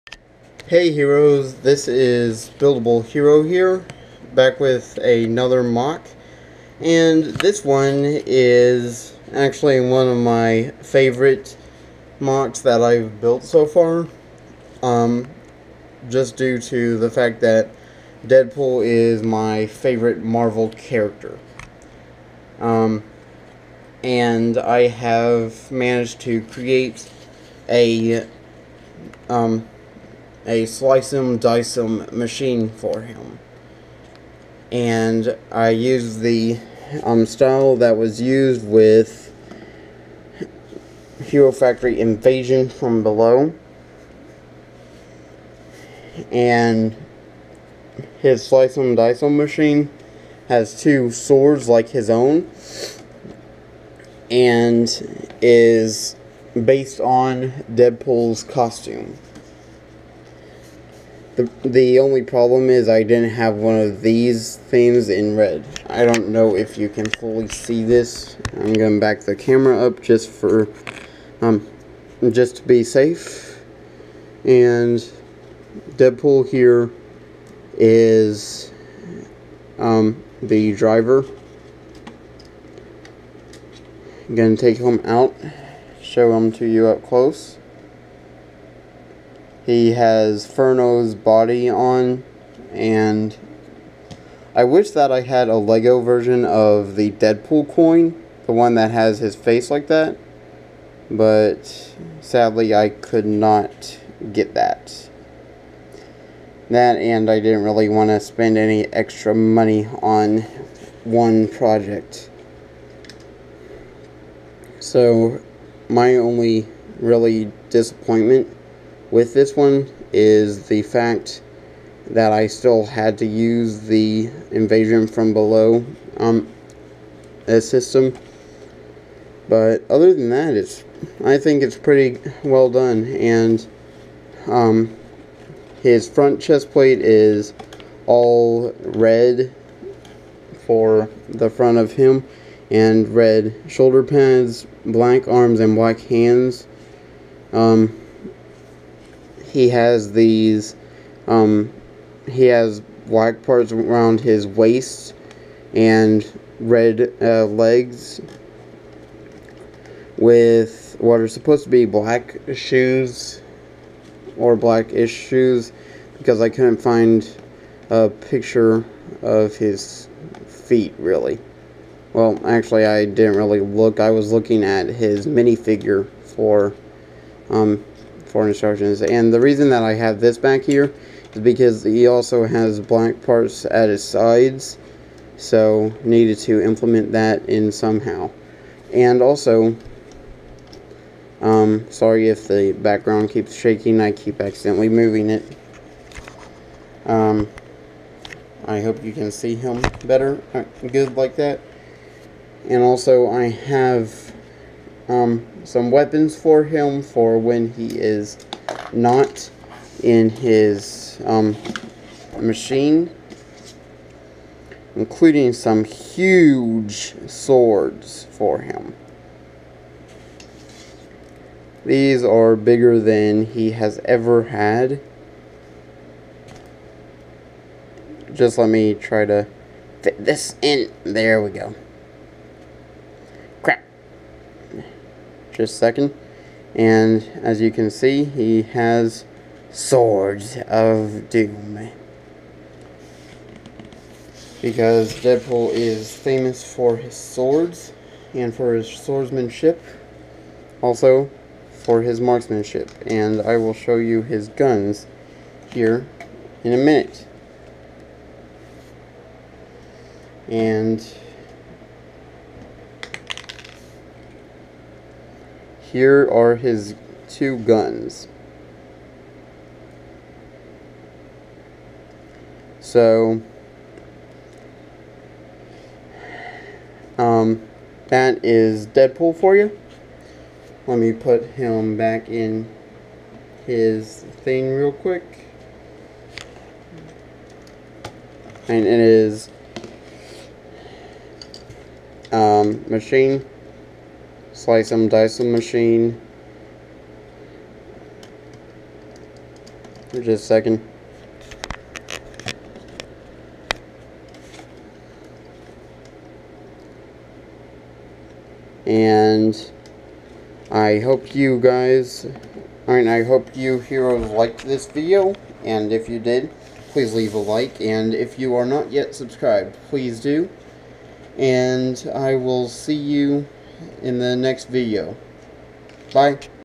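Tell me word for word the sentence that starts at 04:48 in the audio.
And it is um, Machine slice them, dice them machine.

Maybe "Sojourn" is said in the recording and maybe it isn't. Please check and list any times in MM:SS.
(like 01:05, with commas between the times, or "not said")
not said.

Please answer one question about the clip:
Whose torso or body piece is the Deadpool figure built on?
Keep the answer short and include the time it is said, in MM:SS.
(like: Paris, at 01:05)
Furno, at 01:30.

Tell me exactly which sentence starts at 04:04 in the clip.
Because Deadpool is famous for his swords and for his swordsmanship.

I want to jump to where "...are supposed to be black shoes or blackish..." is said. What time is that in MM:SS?
02:41.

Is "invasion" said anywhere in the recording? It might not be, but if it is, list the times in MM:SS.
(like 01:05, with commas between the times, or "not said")
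00:41, 02:04.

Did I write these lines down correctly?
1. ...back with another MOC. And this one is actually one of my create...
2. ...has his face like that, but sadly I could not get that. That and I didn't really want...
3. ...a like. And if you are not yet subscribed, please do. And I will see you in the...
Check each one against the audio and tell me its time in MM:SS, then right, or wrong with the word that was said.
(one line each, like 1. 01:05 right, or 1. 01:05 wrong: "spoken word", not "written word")
1. 00:04 wrong: "favorite", not "create"
2. 01:38 right
3. 05:17 right.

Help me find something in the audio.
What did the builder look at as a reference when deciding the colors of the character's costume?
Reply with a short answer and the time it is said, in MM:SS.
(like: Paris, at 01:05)
his minifigure, at 02:54.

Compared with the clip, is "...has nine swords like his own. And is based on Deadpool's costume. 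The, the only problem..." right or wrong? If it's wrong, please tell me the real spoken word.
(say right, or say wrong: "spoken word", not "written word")
wrong: "two", not "nine".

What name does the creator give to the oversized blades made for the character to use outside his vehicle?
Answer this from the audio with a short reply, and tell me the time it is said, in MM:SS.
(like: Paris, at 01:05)
Swords of Doom, at 03:59.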